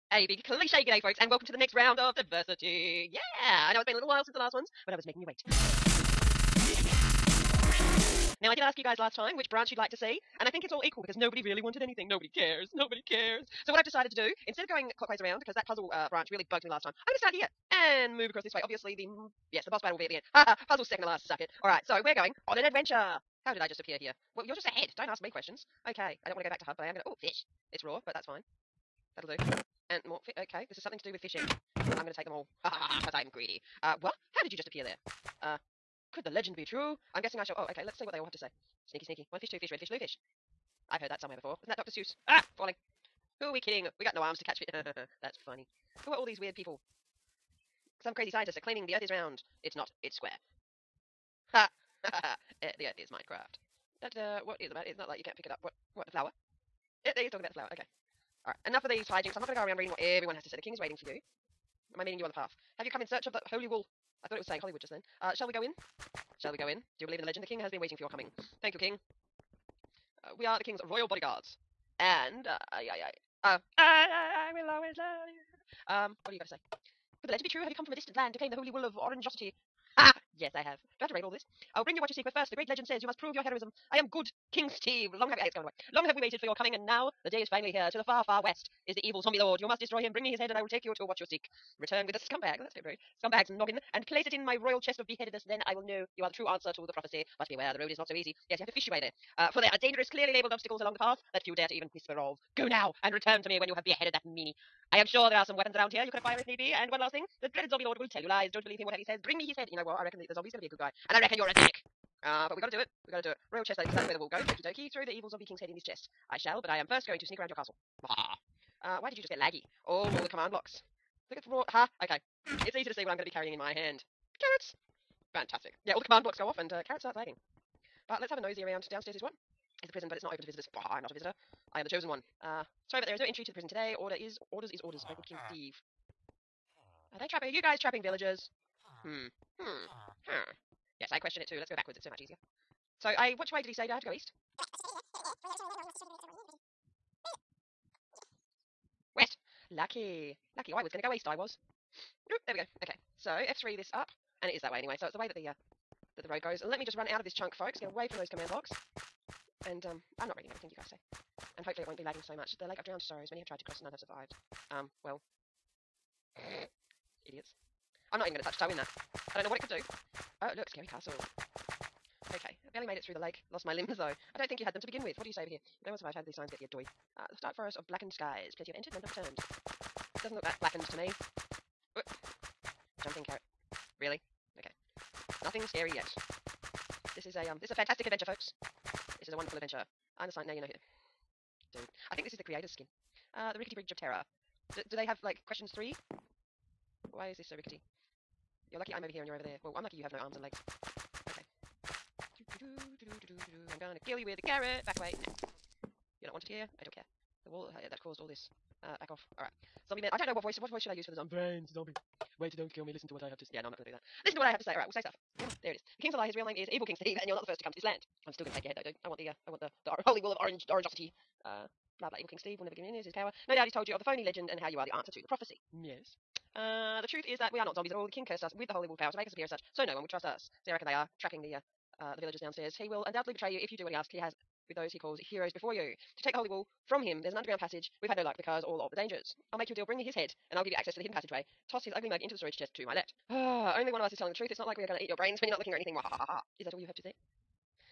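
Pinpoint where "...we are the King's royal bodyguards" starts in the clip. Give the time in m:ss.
1:10.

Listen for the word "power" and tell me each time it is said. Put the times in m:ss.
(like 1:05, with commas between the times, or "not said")
3:43, 3:48.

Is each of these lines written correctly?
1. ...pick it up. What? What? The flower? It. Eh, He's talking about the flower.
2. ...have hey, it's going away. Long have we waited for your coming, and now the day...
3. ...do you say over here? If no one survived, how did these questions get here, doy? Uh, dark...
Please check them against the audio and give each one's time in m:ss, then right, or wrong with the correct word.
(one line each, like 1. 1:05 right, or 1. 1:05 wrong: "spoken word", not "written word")
1. 0:55 right
2. 1:25 right
3. 2:55 wrong: "signs", not "questions".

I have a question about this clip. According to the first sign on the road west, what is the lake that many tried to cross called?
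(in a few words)
Lake of drowned sorrows.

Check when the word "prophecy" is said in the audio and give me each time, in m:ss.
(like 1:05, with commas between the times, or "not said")
1:36, 3:45.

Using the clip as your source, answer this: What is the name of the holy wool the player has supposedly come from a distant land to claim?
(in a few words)
Holy wool of orangeosity.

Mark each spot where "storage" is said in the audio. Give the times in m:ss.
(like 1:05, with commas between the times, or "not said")
4:02.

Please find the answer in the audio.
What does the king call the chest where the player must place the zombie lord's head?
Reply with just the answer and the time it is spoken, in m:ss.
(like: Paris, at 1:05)
Royal chest of beheadedness, at 1:34.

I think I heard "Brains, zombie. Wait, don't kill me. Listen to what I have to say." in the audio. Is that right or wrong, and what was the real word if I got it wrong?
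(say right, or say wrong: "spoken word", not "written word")
right.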